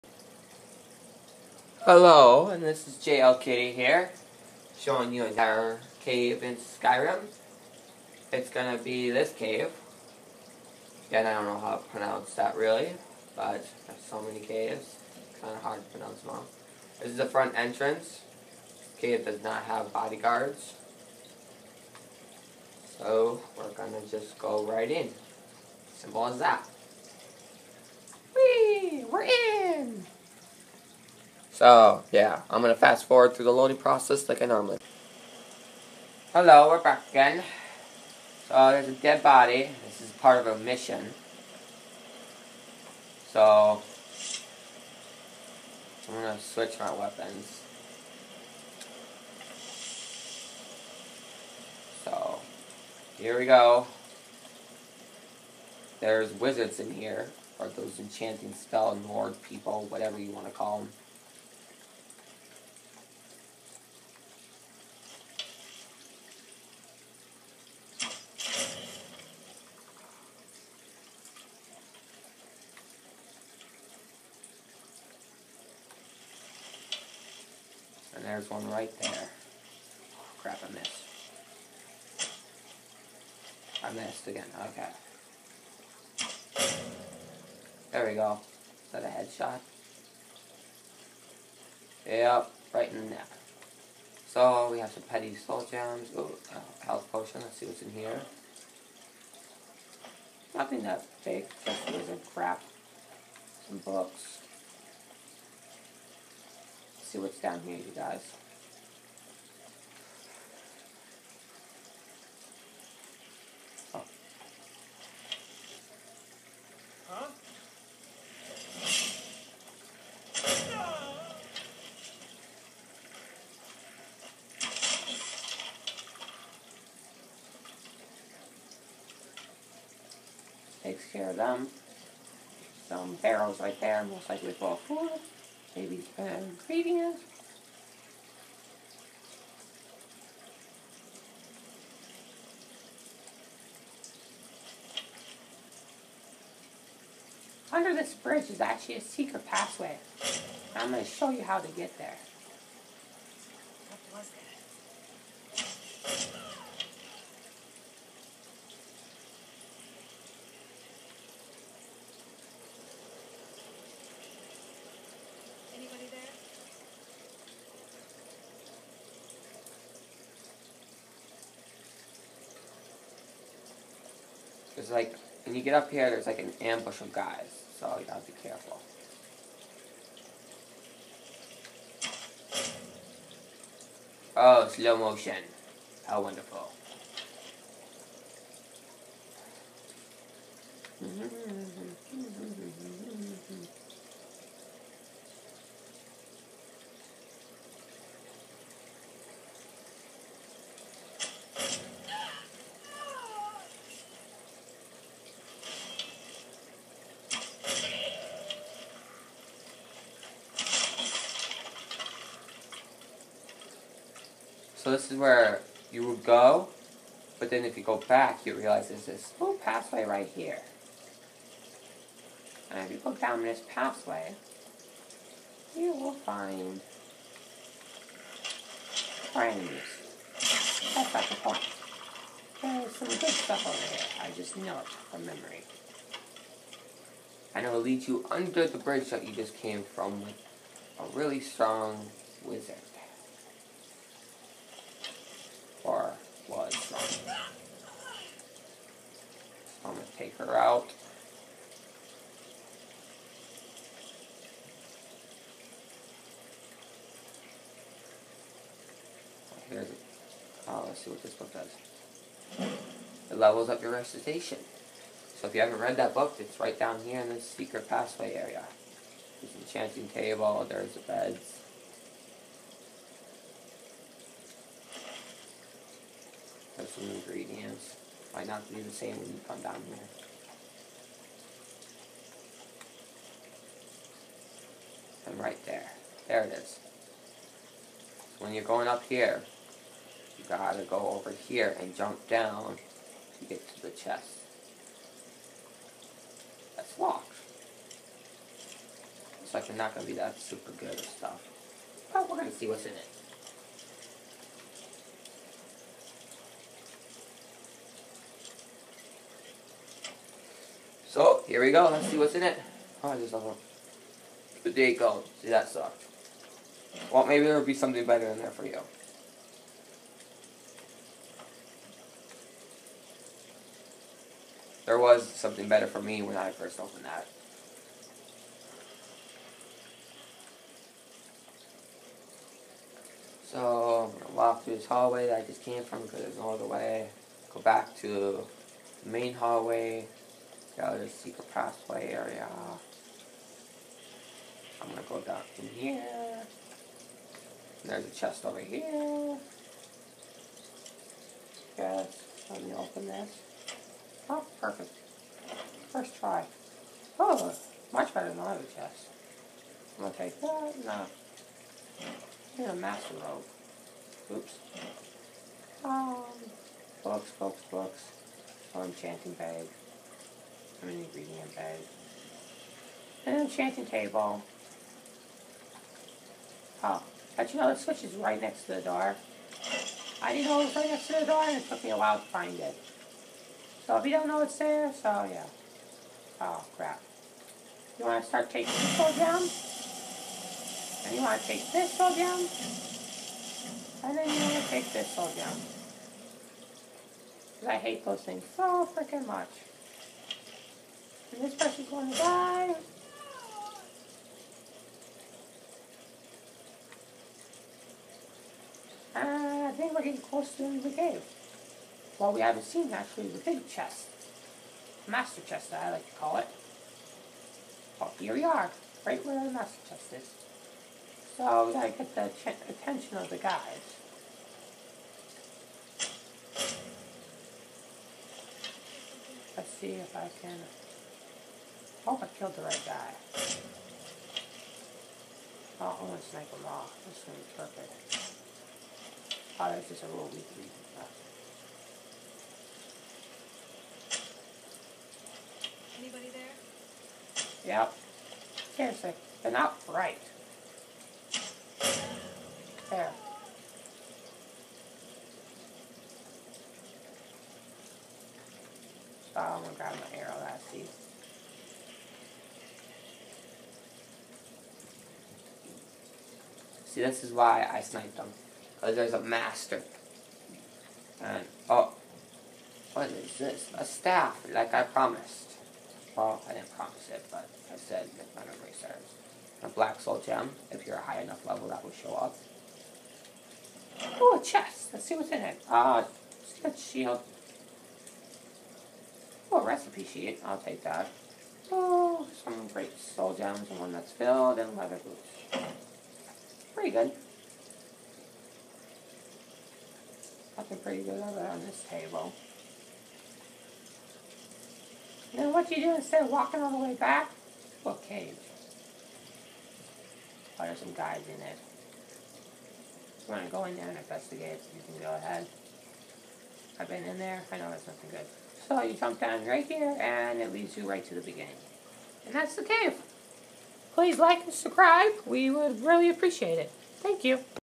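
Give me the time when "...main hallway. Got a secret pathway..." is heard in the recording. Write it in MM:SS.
05:39.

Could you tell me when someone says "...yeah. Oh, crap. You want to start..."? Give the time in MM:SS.
06:25.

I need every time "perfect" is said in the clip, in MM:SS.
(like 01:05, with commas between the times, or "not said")
05:54, 07:17.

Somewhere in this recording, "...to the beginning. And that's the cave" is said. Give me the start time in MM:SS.
08:41.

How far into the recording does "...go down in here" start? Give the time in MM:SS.
05:45.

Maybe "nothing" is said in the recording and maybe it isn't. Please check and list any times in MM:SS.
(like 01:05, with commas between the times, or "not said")
01:40, 08:37.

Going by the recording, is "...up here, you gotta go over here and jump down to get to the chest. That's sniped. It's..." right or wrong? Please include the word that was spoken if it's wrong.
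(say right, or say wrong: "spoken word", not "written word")
wrong: "locked", not "sniped".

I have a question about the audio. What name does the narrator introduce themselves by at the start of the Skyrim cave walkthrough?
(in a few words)
JL Kitty.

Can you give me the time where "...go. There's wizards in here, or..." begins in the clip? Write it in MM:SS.
00:53.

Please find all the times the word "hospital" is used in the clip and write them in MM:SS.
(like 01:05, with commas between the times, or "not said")
not said.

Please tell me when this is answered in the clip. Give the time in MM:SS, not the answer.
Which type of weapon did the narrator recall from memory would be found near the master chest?
07:53.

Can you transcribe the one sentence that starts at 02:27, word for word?
Under this bridge is actually a secret pathway.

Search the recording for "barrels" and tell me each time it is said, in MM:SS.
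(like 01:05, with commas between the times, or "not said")
02:13.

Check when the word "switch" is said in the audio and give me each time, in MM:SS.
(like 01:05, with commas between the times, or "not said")
00:46, 06:17.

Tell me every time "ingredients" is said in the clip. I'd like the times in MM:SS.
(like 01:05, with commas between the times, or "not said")
04:37, 06:10.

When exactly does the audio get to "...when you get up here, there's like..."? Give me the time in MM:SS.
02:55.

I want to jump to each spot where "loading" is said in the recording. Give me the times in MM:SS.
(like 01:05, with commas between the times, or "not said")
00:33.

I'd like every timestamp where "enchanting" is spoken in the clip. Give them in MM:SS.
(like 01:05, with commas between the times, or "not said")
00:57, 04:29, 06:08, 06:13.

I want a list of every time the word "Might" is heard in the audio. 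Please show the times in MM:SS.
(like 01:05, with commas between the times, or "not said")
04:38.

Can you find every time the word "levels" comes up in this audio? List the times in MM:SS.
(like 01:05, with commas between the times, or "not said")
04:23, 08:01.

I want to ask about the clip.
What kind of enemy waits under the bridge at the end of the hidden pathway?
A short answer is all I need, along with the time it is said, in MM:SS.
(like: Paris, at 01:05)
A really strong wizard, at 04:00.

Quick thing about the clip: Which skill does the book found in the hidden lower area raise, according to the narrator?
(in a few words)
Recitation.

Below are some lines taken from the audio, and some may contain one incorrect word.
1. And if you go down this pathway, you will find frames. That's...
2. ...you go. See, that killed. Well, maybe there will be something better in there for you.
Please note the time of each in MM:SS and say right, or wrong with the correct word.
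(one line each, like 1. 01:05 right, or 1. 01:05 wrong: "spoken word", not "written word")
1. 03:42 right
2. 05:14 wrong: "sucked", not "killed".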